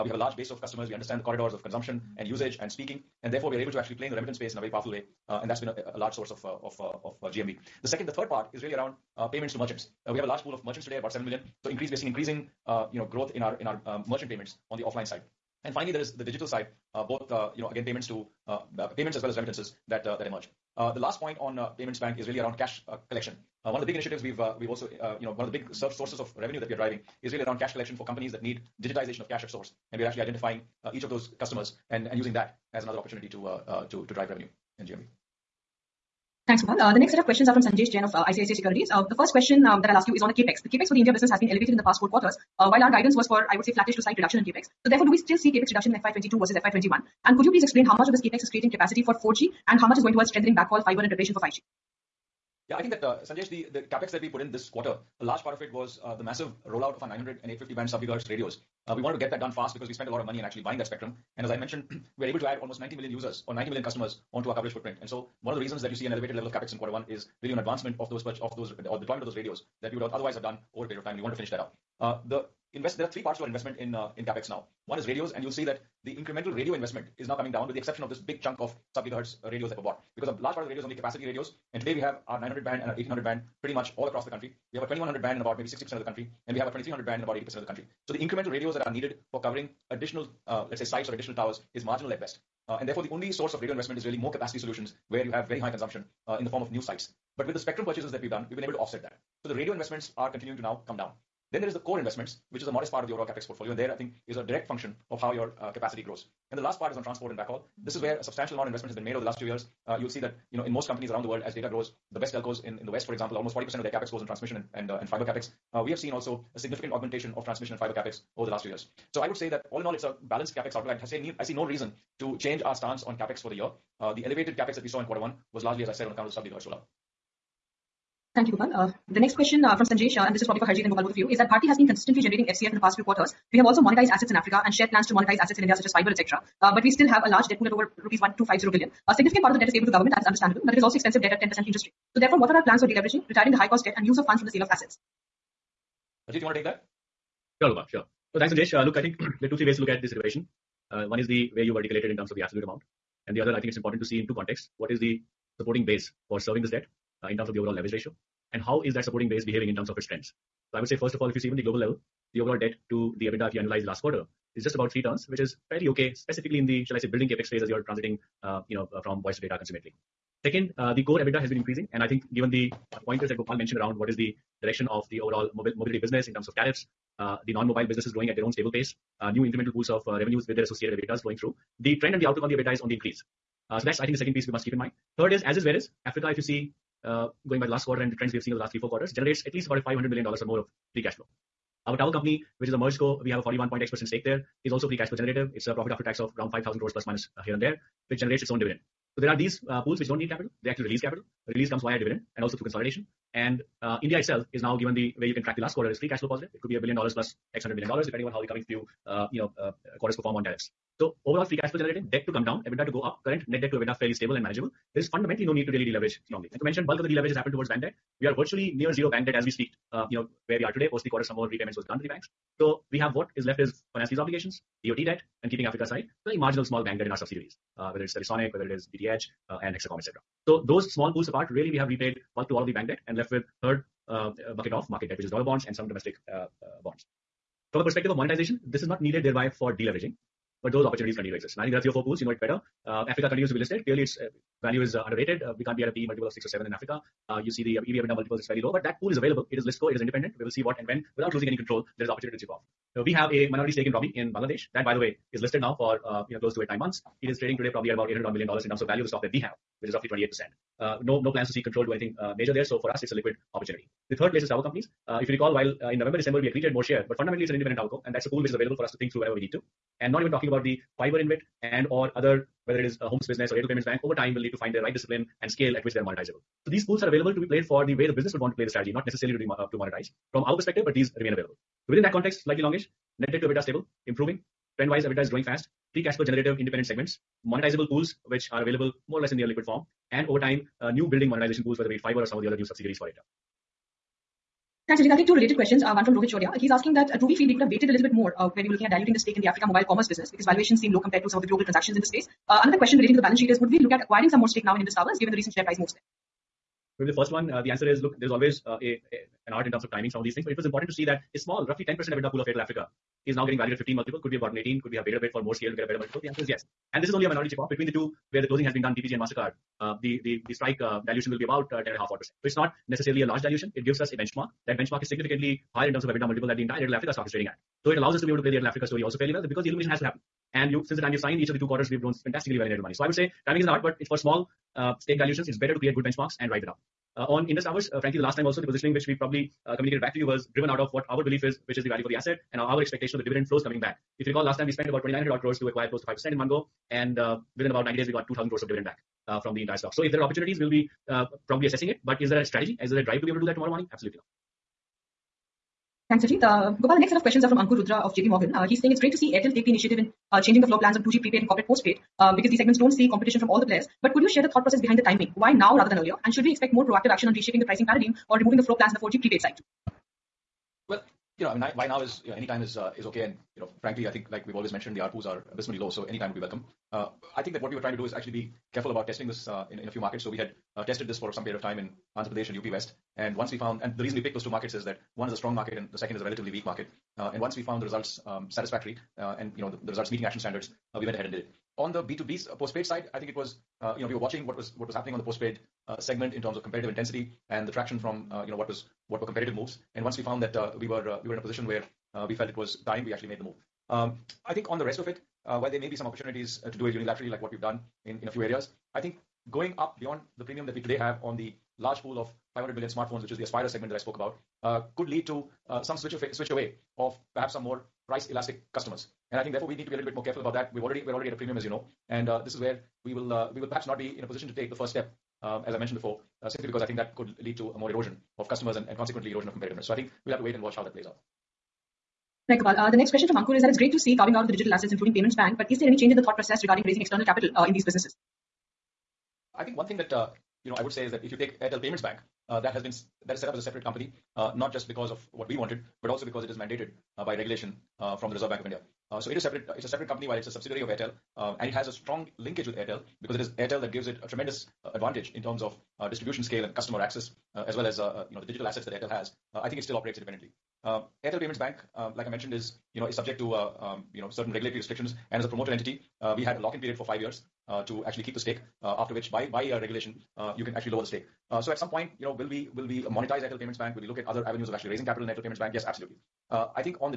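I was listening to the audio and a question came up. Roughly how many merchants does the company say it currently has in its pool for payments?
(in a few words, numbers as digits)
7 million.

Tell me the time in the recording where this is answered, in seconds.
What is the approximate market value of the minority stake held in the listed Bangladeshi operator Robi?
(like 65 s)
257 s.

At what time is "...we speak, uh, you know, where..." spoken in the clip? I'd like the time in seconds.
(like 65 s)
219 s.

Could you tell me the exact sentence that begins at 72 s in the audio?
Uh, there are three parts to our investment in uh, in CapEx now.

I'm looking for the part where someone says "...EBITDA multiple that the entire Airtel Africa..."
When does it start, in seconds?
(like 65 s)
326 s.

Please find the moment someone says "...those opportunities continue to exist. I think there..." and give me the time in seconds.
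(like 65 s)
240 s.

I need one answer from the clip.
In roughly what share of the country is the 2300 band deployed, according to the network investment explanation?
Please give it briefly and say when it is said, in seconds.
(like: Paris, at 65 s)
80%, at 87 s.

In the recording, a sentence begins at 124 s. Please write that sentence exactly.
Uh, the elevated CapEx that we saw in quarter one was largely, as I said, on account of the sub-gigahertz rollout.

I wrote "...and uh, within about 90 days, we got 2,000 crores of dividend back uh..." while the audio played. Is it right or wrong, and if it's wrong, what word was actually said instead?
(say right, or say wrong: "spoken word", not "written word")
right.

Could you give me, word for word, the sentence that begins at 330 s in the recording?
Since the time we have signed each of the two quarters, we've grown fantastically well in Airtel Money.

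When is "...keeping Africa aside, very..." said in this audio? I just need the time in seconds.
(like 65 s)
225 s.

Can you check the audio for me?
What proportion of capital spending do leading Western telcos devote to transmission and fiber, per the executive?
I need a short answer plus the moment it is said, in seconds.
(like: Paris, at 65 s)
40%, at 113 s.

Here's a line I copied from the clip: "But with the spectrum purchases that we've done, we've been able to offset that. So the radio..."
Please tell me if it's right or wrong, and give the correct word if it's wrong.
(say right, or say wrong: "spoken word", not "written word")
right.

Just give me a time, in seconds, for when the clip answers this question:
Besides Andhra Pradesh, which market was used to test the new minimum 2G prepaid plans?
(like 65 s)
382 s.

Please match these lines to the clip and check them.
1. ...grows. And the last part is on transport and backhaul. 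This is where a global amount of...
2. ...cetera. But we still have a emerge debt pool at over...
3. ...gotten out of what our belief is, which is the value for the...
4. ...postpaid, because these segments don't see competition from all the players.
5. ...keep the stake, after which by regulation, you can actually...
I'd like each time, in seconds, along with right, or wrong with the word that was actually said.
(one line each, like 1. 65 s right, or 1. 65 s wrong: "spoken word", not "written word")
1. 106 s wrong: "substantial", not "global"
2. 136 s wrong: "large", not "emerge"
3. 340 s wrong: "driven", not "gotten"
4. 361 s right
5. 468 s right.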